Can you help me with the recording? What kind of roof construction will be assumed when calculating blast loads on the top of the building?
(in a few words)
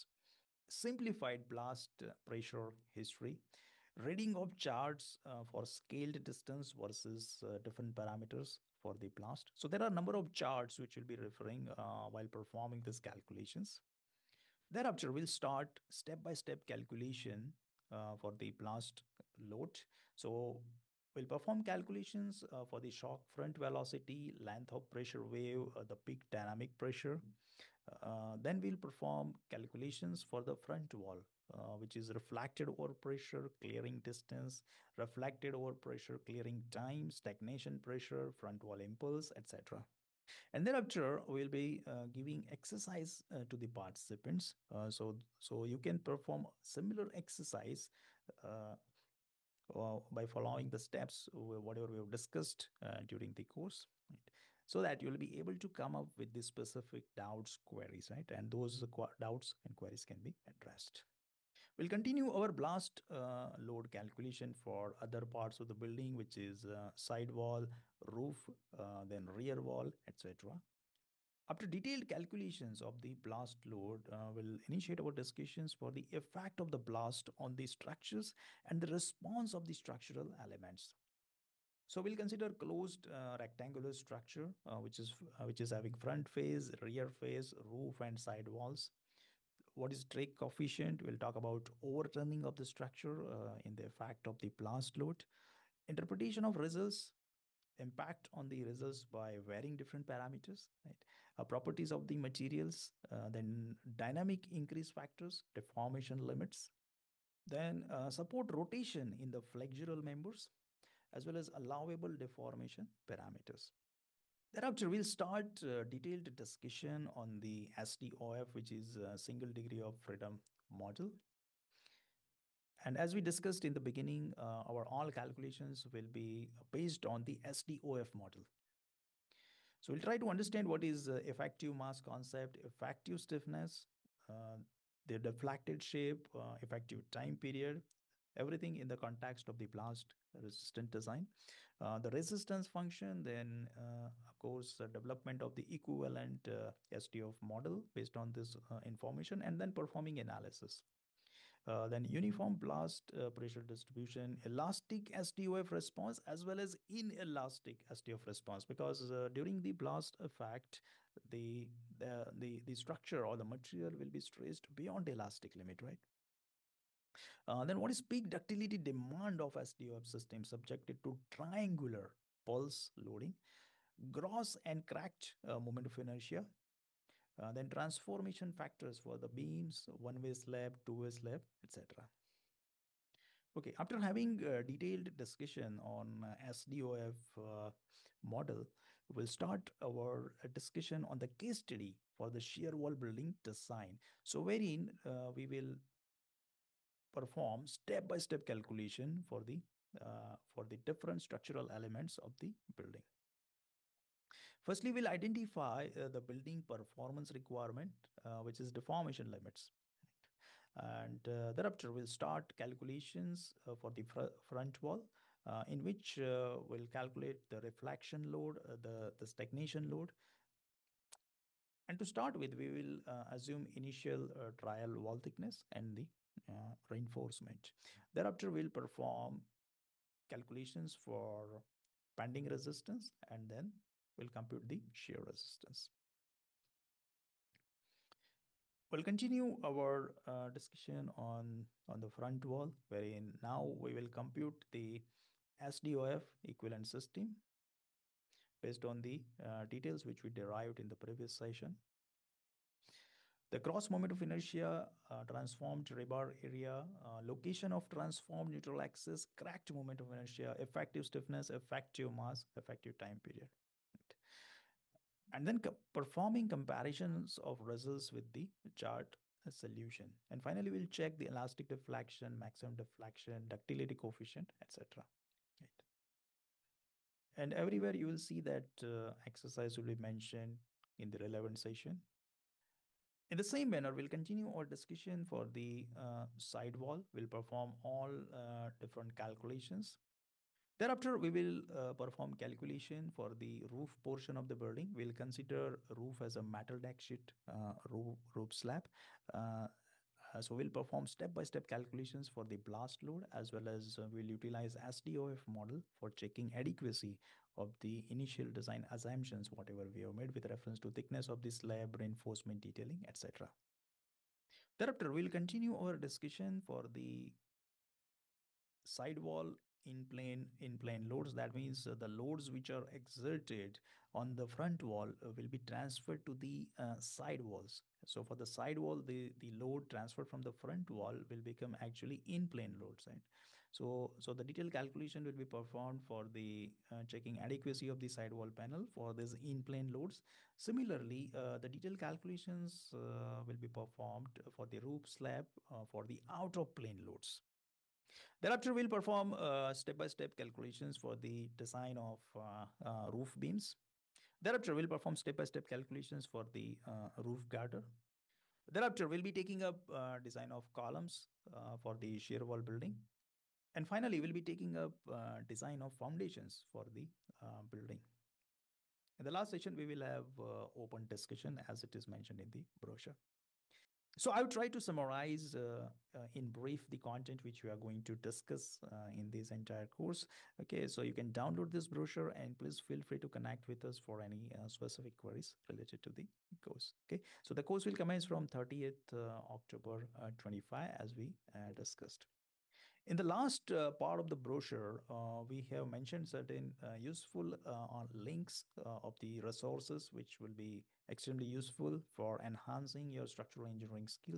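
metal deck sheet.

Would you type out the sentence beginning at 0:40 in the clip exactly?
And thereafter, we'll be uh, giving exercise uh, to the participants.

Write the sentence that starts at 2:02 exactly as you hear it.
And as we discussed in the beginning, uh, our all calculations will be based on the SDOF model.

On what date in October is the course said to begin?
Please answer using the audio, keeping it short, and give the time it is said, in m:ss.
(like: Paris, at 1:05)
30th October, at 6:28.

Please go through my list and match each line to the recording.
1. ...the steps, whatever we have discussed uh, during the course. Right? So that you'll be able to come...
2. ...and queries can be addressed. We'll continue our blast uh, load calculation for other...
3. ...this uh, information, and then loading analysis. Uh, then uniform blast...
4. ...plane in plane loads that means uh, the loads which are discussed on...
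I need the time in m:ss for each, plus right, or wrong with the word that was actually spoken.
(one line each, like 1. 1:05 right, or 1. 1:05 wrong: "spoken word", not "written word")
1. 0:50 right
2. 0:59 right
3. 2:28 wrong: "performing", not "loading"
4. 5:20 wrong: "exerted", not "discussed".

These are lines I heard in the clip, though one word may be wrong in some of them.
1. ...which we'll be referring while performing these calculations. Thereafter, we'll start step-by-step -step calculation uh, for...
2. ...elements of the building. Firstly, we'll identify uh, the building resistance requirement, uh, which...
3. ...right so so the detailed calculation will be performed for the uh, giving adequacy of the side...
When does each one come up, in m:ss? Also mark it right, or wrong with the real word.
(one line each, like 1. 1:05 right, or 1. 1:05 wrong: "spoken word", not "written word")
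1. 0:10 right
2. 3:21 wrong: "performance", not "resistance"
3. 5:33 wrong: "checking", not "giving".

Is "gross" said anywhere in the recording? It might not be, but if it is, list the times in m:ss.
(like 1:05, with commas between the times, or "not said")
2:54, 4:13.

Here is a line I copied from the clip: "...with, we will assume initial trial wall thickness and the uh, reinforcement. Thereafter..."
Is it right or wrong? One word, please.
right.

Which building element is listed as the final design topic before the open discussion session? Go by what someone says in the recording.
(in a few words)
foundations.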